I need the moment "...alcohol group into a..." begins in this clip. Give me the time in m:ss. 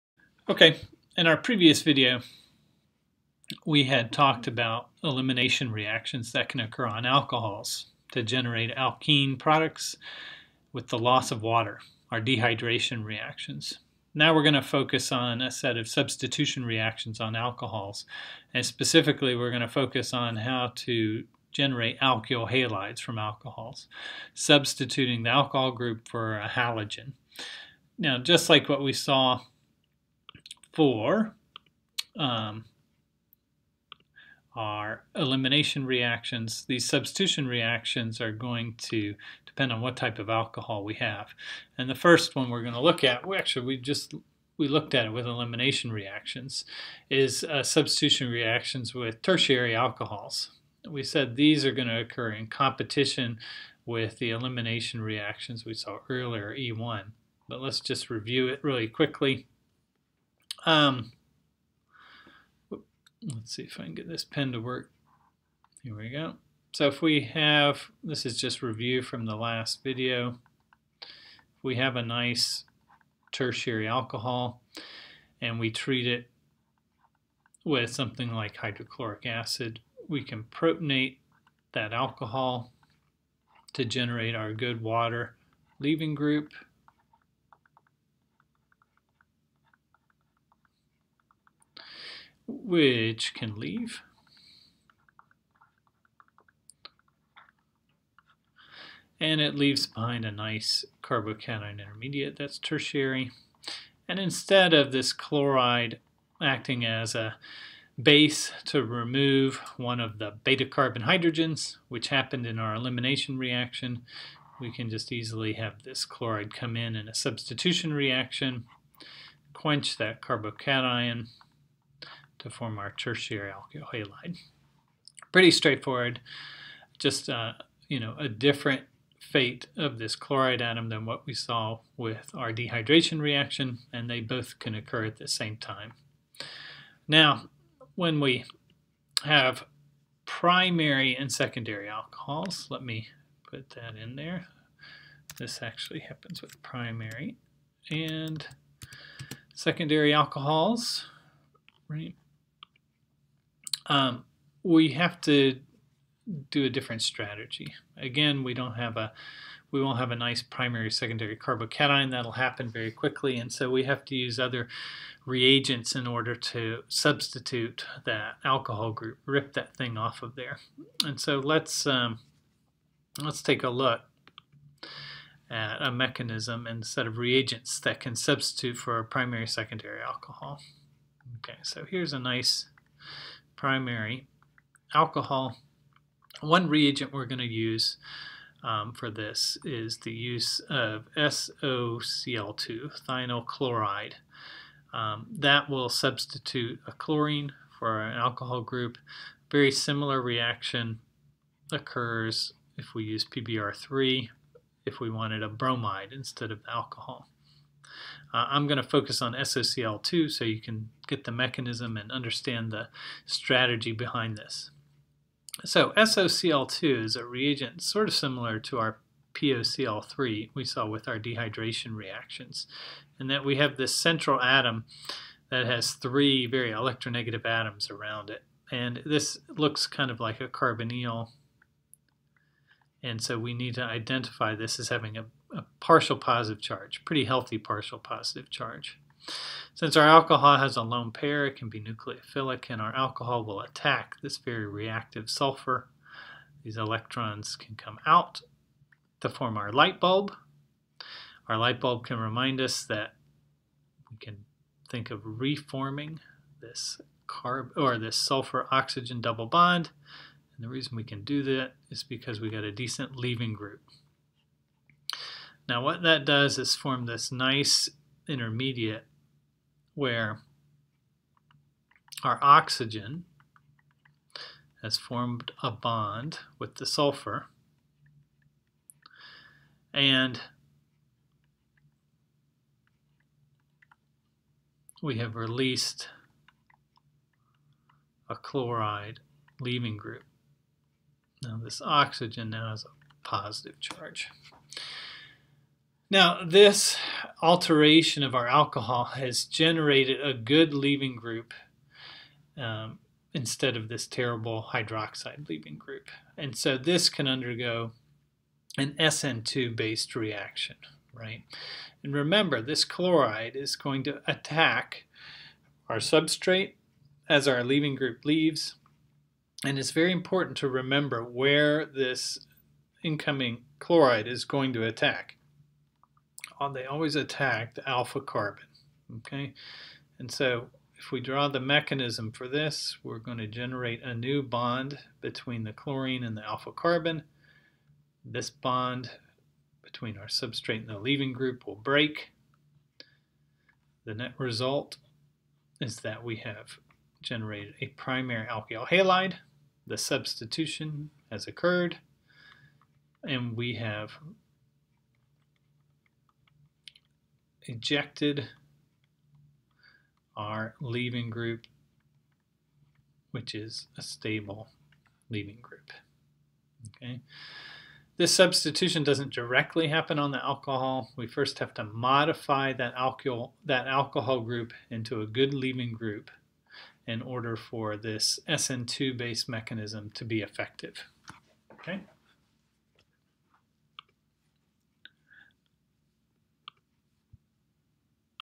6:13.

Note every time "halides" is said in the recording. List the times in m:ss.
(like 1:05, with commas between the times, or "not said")
0:22, 5:48.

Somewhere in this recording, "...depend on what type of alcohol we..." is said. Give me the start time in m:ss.
0:39.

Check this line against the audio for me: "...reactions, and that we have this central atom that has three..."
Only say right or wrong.
right.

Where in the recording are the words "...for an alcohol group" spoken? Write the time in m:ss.
3:17.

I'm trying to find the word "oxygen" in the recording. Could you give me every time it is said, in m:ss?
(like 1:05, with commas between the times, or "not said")
4:18, 4:32, 4:51.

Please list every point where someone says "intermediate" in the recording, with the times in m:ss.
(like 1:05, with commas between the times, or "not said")
1:41, 4:28.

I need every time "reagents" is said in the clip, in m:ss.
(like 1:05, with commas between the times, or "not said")
2:45, 2:57, 3:06, 3:37.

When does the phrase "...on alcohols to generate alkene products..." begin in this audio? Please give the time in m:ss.
0:06.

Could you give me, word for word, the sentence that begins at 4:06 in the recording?
These electrons can come out to form our light bulb.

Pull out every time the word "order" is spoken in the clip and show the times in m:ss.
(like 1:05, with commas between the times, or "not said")
2:46, 6:17.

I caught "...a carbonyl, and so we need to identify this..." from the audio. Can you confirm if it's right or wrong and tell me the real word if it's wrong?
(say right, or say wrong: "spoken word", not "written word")
right.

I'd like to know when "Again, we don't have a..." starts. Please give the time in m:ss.
2:37.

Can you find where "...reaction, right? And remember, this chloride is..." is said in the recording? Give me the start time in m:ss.
5:10.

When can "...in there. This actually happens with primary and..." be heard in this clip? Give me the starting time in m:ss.
2:23.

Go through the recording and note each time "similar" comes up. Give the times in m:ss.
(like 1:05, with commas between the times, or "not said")
3:19, 3:38.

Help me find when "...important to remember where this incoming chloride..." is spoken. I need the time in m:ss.
5:20.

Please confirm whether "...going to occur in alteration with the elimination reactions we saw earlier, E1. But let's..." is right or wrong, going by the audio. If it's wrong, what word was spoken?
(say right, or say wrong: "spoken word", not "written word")
wrong: "competition", not "alteration".